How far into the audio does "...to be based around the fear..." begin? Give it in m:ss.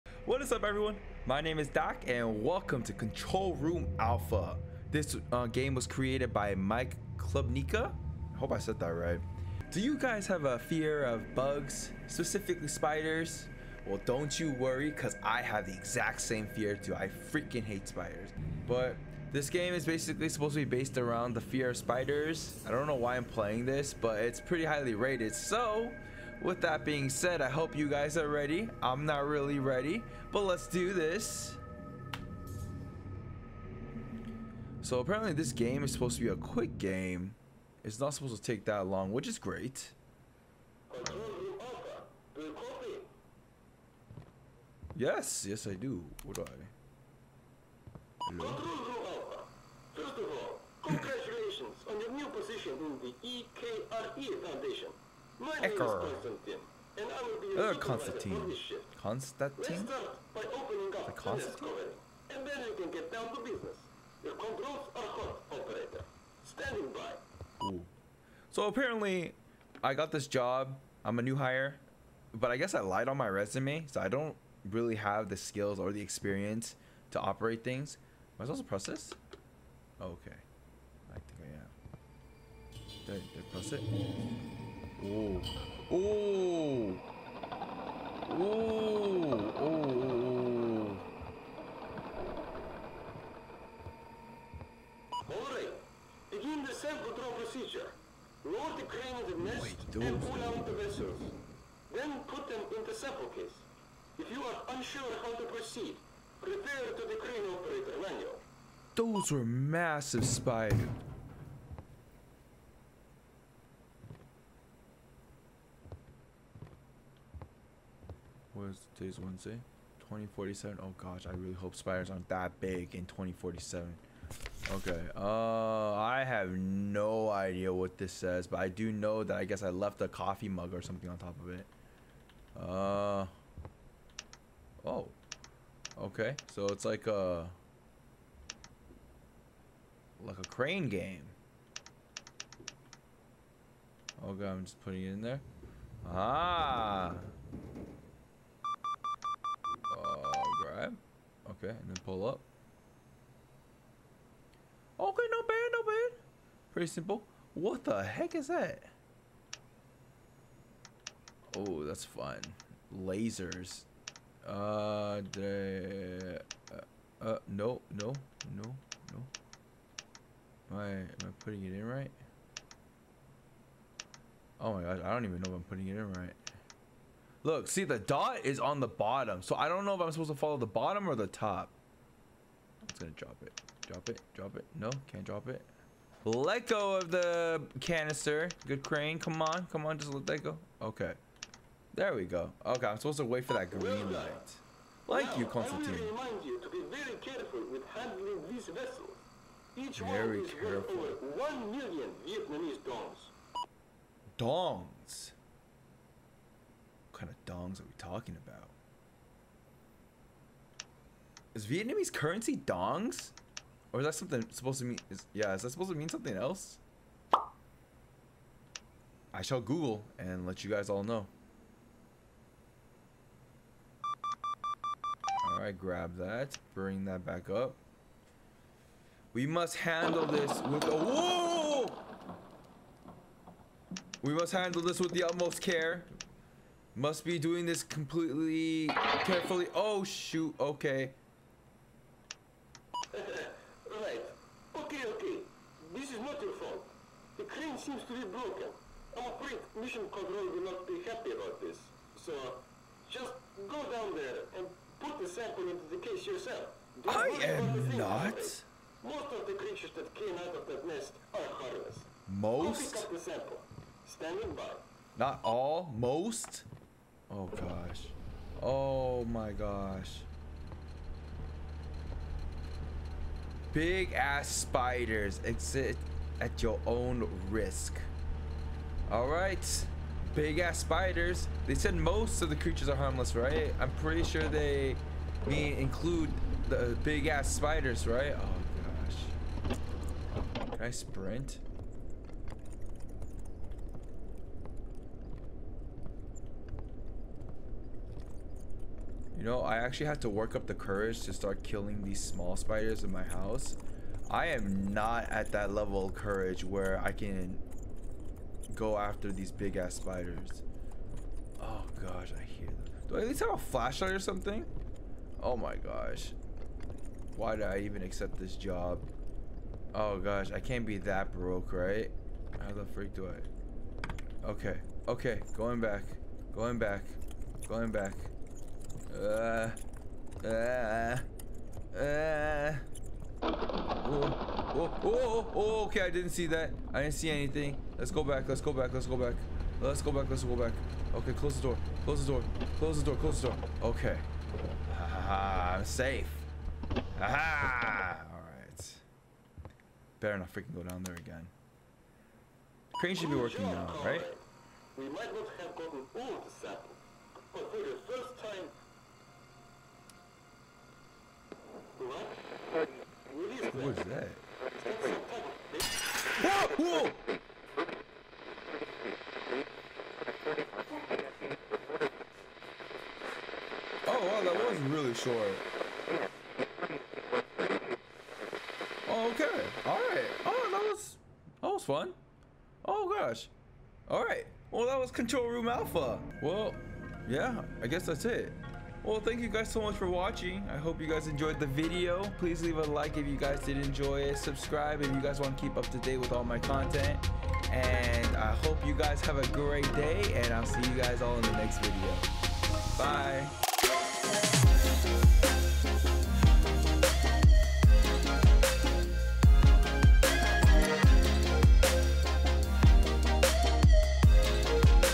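0:20.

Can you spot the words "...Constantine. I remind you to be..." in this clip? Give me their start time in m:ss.
3:15.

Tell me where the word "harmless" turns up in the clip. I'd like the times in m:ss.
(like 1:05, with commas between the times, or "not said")
4:21, 4:42.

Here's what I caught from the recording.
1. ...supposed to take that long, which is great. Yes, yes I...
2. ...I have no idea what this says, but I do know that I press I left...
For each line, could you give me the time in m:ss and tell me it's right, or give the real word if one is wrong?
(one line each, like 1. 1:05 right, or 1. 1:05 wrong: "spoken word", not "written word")
1. 0:38 right
2. 2:05 wrong: "guess", not "press".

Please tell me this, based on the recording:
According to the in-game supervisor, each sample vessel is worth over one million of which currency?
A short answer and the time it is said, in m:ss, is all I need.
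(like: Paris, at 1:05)
Vietnamese dongs, at 3:22.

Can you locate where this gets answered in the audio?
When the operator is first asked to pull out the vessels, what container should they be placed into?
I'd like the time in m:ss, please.
1:42.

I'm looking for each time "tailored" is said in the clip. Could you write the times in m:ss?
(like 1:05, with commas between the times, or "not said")
not said.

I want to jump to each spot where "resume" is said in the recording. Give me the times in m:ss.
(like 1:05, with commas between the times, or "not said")
1:13.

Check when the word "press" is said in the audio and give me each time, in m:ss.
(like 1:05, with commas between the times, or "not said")
1:18, 1:23.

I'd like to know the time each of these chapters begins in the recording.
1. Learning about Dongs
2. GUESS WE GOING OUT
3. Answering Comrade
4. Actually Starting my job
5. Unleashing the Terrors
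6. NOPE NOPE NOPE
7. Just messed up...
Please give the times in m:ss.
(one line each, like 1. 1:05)
1. 3:20
2. 4:30
3. 0:40
4. 2:19
5. 1:15
6. 5:30
7. 3:50.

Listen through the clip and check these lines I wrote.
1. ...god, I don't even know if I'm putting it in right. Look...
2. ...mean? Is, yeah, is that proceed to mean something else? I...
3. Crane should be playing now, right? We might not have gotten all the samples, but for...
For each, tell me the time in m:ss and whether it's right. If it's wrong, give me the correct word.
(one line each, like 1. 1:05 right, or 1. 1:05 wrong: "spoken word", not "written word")
1. 2:54 right
2. 3:34 wrong: "supposed", not "proceed"
3. 5:52 wrong: "working", not "playing".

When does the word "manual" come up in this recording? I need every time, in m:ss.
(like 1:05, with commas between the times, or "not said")
1:47.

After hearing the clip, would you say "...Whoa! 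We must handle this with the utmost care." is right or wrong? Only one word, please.
right.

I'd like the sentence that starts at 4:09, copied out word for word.
I'm afraid Mission Control will not be happy about this.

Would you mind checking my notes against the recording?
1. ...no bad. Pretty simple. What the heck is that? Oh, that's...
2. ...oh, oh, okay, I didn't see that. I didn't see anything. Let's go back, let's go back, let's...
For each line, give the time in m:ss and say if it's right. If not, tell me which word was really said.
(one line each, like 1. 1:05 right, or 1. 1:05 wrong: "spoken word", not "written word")
1. 2:35 right
2. 5:35 right.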